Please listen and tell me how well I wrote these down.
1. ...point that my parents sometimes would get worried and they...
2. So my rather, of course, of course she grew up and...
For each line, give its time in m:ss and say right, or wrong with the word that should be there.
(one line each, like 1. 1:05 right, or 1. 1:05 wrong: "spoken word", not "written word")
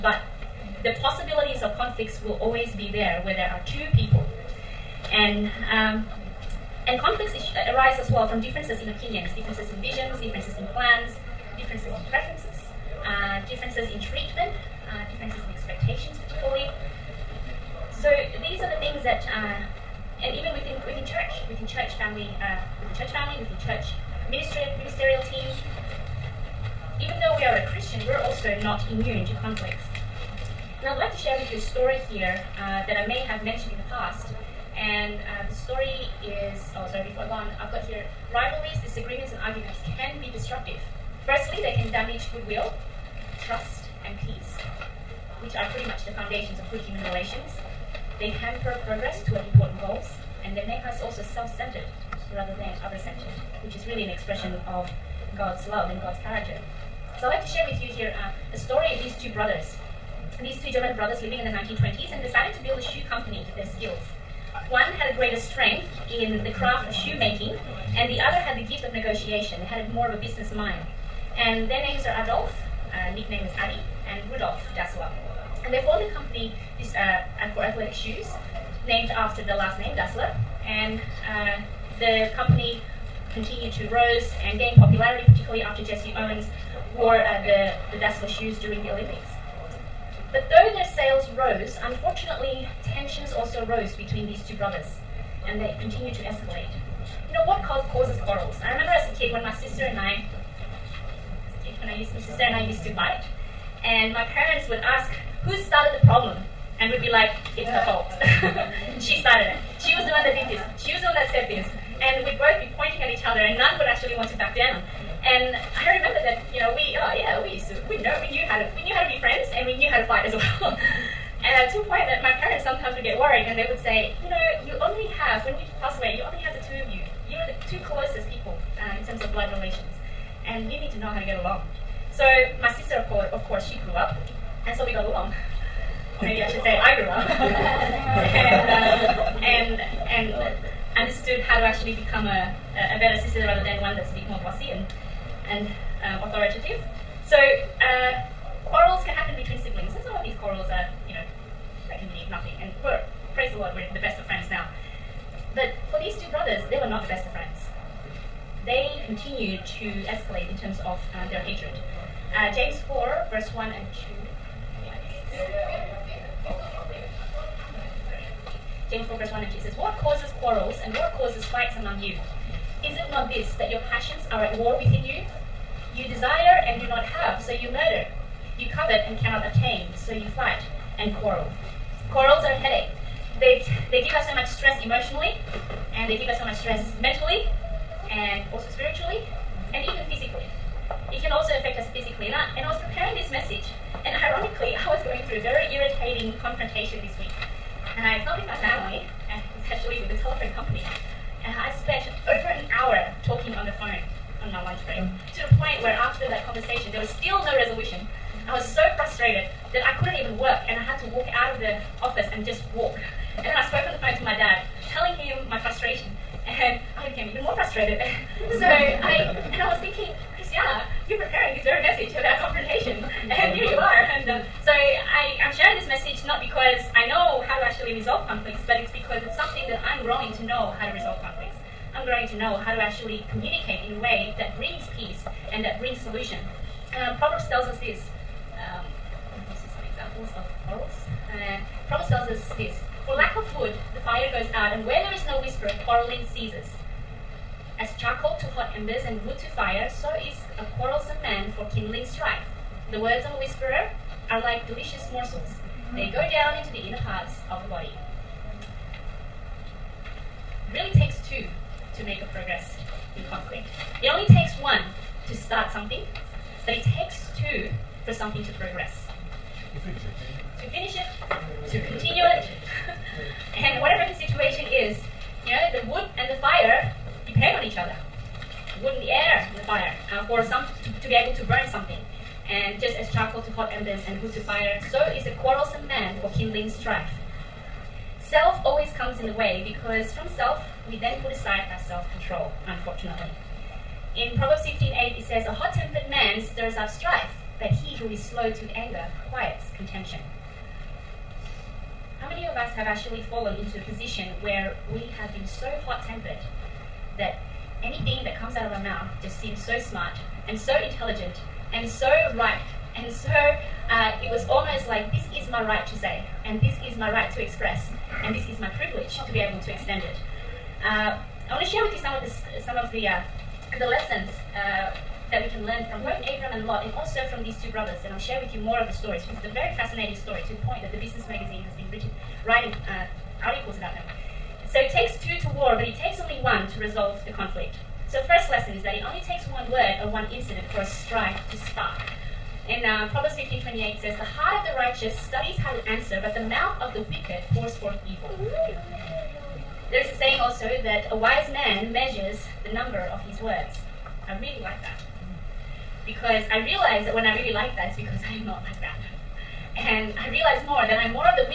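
1. 2:01 right
2. 2:12 wrong: "sister", not "rather".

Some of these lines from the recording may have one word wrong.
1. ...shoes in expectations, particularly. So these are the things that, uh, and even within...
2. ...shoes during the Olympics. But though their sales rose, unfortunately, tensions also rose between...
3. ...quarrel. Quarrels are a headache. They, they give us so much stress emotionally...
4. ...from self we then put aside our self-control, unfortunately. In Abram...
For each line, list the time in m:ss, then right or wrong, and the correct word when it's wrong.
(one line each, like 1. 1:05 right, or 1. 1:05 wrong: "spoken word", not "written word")
1. 0:15 wrong: "differences", not "shoes"
2. 1:28 right
3. 3:01 right
4. 4:50 wrong: "Proverbs", not "Abram".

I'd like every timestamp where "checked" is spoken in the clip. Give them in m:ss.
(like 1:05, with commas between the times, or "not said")
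not said.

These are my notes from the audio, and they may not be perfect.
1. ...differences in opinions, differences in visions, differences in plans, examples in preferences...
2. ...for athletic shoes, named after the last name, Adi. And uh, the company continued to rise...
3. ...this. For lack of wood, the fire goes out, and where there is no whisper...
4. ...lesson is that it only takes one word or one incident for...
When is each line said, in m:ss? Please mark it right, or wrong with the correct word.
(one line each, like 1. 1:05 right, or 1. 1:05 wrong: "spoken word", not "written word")
1. 0:08 wrong: "differences", not "examples"
2. 1:17 wrong: "Dassler", not "Adi"
3. 4:02 right
4. 5:38 right.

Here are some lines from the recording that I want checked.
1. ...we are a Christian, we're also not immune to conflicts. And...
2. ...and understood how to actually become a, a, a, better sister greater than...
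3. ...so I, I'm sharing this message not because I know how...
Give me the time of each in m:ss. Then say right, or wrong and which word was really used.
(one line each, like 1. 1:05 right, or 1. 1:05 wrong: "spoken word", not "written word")
1. 0:27 right
2. 2:20 wrong: "rather", not "greater"
3. 3:44 right.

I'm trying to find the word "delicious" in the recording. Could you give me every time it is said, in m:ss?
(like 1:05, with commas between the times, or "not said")
4:14.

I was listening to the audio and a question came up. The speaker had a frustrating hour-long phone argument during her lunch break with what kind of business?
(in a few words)
A telephone company.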